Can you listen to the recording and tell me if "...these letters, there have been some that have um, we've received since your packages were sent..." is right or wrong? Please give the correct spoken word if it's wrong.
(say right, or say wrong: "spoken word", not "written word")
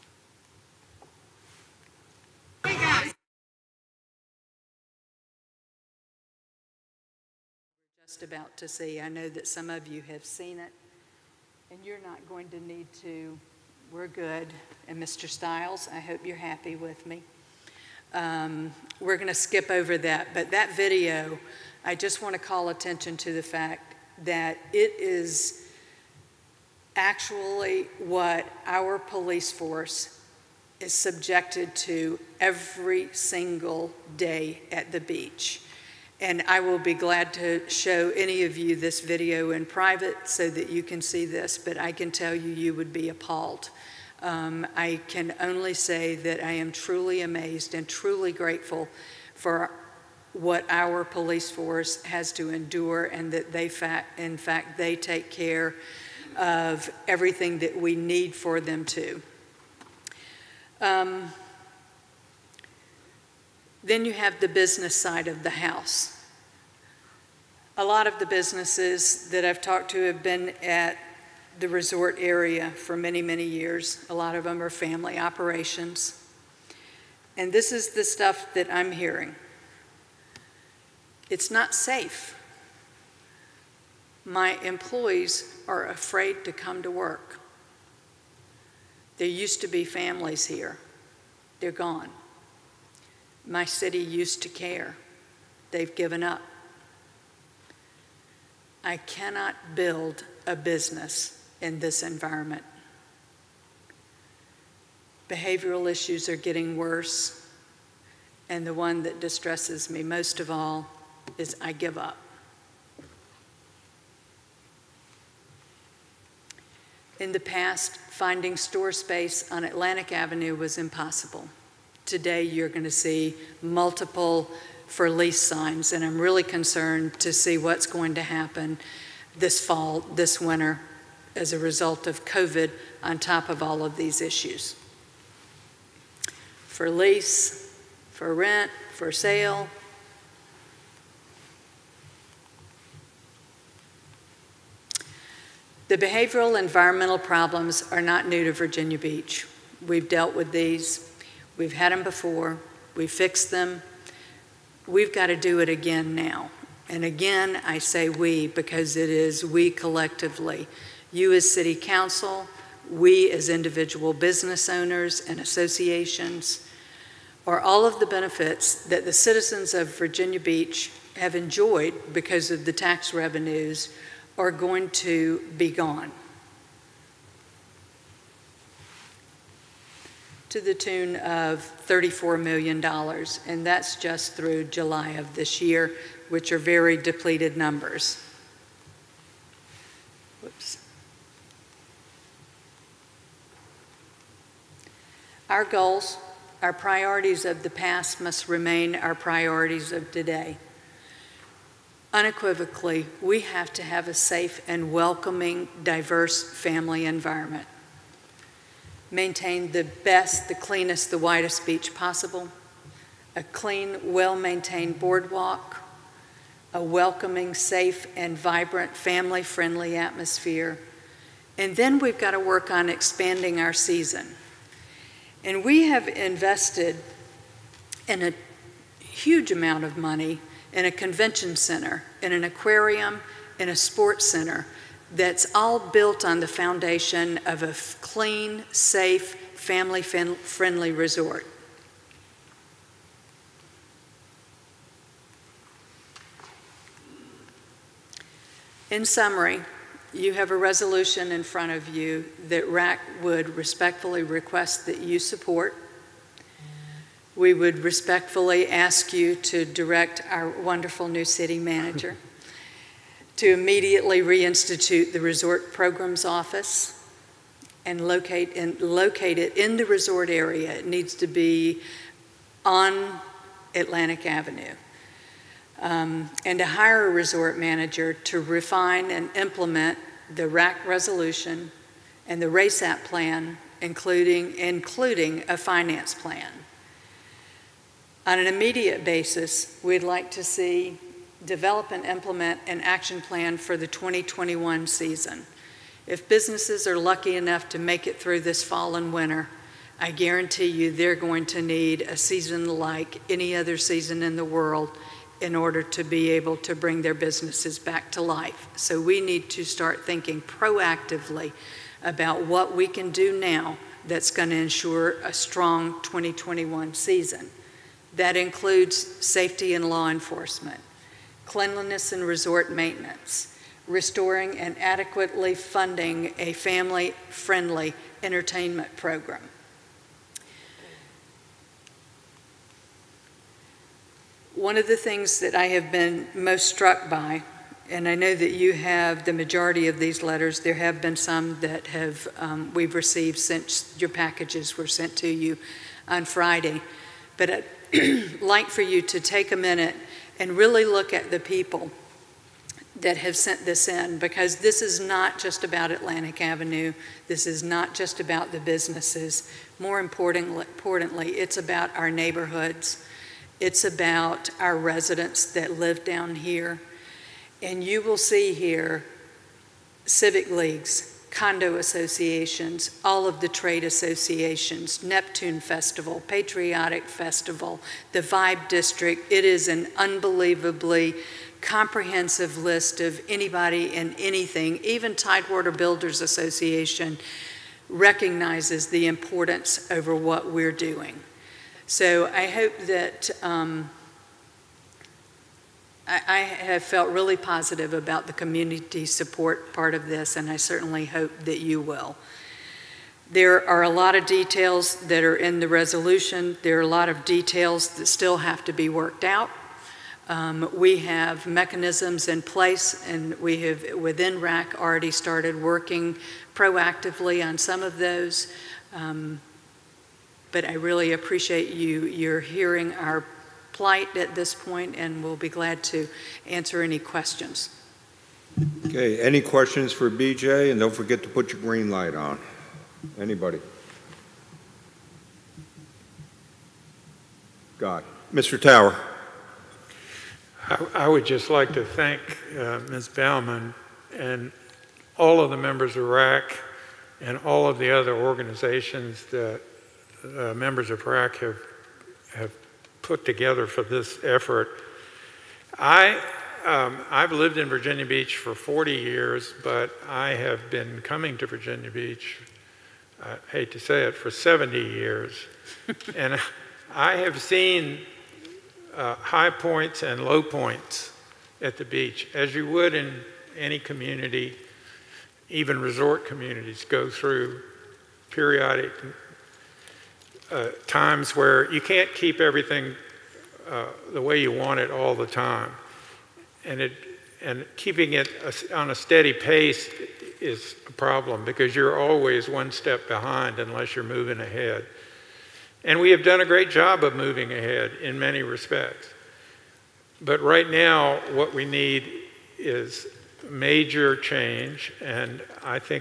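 right.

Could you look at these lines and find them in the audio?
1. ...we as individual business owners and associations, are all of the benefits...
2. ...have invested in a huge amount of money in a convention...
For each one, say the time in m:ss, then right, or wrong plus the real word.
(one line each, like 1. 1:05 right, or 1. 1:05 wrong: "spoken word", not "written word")
1. 2:42 right
2. 3:45 right.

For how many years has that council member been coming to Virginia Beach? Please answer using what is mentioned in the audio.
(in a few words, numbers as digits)
70 years.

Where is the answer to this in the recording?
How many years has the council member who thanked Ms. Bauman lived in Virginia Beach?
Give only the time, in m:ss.
7:38.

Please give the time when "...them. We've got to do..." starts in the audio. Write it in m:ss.
2:33.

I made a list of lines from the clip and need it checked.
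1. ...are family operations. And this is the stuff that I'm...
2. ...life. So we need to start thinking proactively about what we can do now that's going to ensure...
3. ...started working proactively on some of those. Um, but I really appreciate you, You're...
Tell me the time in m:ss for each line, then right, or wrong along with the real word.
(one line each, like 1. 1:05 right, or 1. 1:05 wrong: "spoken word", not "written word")
1. 1:14 right
2. 5:08 right
3. 6:55 right.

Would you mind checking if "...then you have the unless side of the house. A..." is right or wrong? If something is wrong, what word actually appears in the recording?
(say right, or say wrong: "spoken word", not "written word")
wrong: "business", not "unless".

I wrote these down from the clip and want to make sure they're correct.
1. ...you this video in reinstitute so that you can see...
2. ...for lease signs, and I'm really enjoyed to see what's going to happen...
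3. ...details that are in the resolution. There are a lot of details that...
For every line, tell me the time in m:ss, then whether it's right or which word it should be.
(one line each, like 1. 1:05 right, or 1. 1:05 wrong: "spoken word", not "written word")
1. 0:38 wrong: "private", not "reinstitute"
2. 2:04 wrong: "concerned", not "enjoyed"
3. 6:44 right.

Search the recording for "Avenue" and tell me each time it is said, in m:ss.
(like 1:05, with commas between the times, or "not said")
2:00, 4:34, 5:56.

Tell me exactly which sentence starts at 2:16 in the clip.
For lease, for rent, for sale.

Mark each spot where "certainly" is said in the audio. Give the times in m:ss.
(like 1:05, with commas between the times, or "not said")
6:40.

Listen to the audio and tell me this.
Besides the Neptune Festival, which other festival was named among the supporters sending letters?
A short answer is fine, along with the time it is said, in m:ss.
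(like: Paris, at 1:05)
Patriotic Festival, at 6:16.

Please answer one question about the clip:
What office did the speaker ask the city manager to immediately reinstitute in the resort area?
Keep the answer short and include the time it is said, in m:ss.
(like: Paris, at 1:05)
Resort Programs Office, at 4:25.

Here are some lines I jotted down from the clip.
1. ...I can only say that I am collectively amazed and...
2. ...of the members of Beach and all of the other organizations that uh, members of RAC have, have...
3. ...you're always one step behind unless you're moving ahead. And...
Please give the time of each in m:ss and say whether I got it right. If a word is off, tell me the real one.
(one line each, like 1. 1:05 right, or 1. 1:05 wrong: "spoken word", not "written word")
1. 0:44 wrong: "truly", not "collectively"
2. 7:25 wrong: "RAC", not "Beach"
3. 8:11 right.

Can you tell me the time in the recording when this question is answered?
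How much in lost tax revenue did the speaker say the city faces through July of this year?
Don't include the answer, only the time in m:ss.
3:01.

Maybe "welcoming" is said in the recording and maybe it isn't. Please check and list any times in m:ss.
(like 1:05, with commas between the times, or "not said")
3:24, 3:36.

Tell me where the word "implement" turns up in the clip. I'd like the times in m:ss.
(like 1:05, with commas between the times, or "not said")
4:39, 4:52.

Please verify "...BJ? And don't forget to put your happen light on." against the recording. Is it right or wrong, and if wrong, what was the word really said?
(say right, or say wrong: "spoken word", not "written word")
wrong: "green", not "happen".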